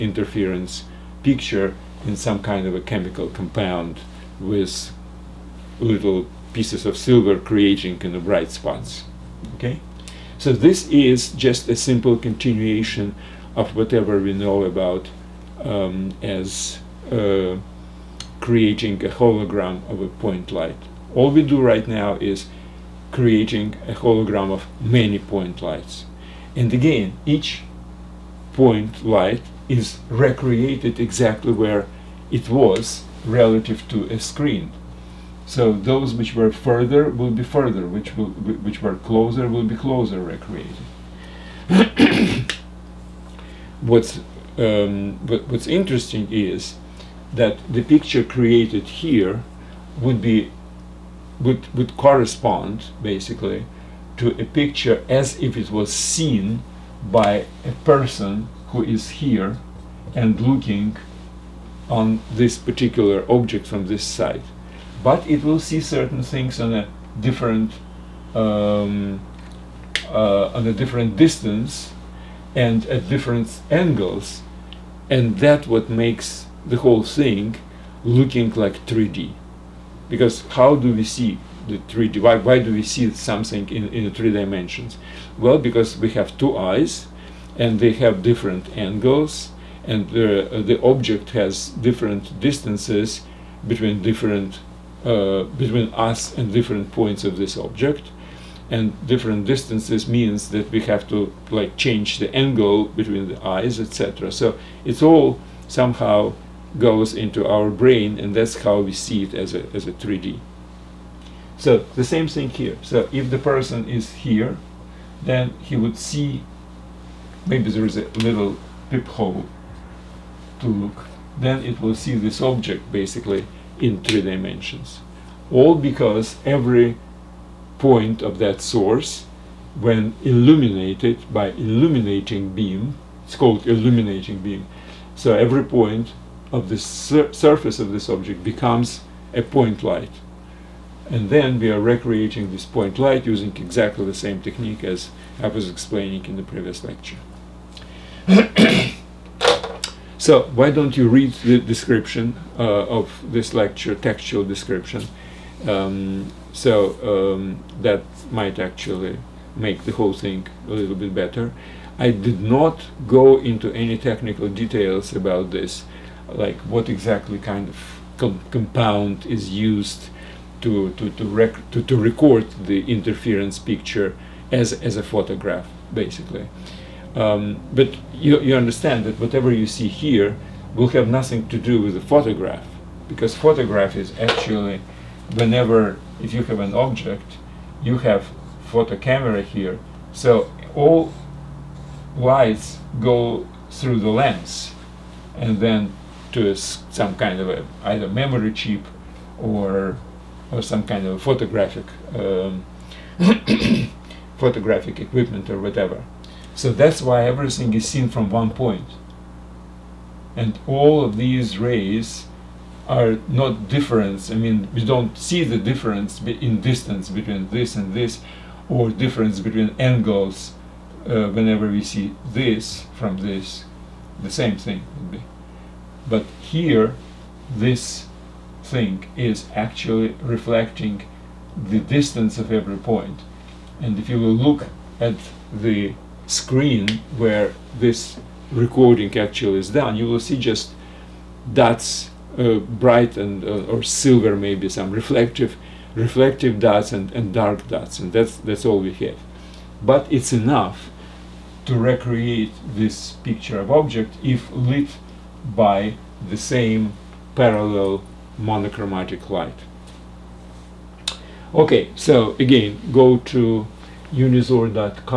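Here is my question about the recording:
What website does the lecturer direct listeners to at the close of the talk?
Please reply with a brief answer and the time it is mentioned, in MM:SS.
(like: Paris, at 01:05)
unizor.com, at 04:24.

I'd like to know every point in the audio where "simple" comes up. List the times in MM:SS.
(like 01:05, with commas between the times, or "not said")
00:11.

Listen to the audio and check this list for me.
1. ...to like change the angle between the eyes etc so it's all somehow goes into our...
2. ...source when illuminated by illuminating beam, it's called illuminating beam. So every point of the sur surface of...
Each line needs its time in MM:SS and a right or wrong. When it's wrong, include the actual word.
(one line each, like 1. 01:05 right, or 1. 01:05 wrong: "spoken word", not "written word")
1. 01:41 right
2. 02:08 right.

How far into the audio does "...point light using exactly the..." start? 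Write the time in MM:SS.
02:22.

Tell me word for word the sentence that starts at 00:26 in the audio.
And again, each point light is recreated exactly where it was relative to a screen.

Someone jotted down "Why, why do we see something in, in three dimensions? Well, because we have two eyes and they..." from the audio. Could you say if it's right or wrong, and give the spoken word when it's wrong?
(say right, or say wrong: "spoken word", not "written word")
right.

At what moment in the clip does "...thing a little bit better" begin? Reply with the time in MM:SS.
02:40.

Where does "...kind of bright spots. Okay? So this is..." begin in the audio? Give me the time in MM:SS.
00:07.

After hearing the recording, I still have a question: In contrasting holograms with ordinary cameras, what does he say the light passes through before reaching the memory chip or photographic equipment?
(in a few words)
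the lens.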